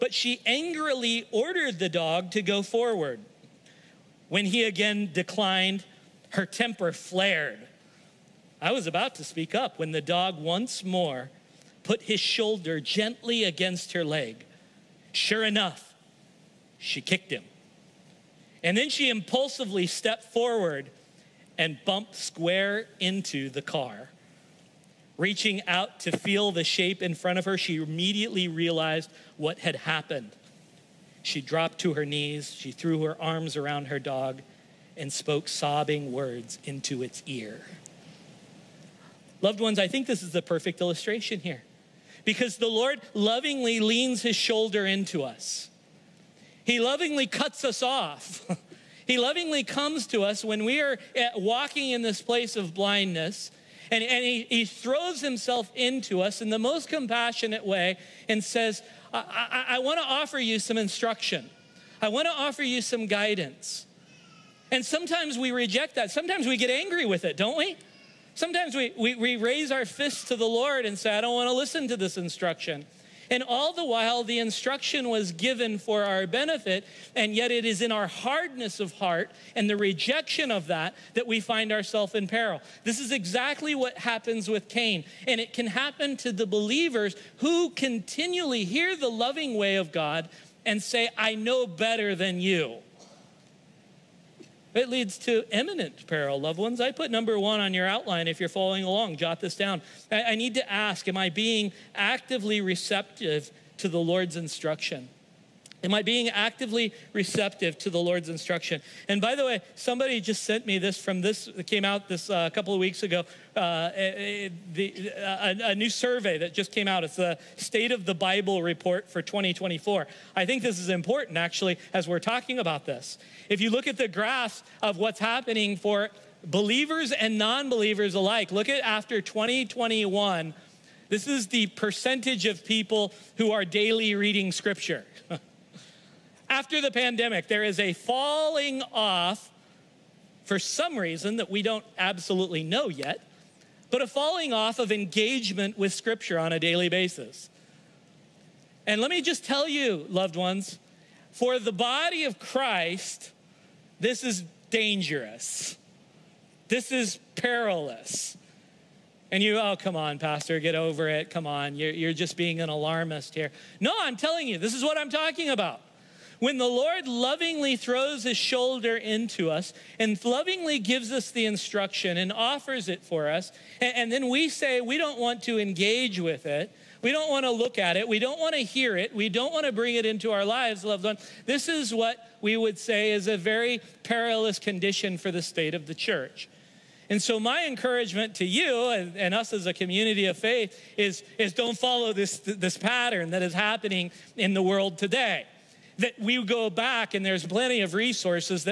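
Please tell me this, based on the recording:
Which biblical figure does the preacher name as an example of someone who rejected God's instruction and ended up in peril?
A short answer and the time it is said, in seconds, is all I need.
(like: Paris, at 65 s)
Cain, at 84 s.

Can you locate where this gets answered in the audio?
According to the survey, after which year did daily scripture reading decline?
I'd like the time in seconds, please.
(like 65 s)
129 s.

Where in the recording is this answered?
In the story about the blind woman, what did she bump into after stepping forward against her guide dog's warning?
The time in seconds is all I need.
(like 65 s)
23 s.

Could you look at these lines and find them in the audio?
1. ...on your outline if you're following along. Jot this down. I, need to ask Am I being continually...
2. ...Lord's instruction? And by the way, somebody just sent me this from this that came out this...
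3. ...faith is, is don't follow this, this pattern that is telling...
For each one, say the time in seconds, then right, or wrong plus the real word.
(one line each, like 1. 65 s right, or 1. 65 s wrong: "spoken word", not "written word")
1. 97 s wrong: "actively", not "continually"
2. 107 s right
3. 190 s wrong: "happening", not "telling".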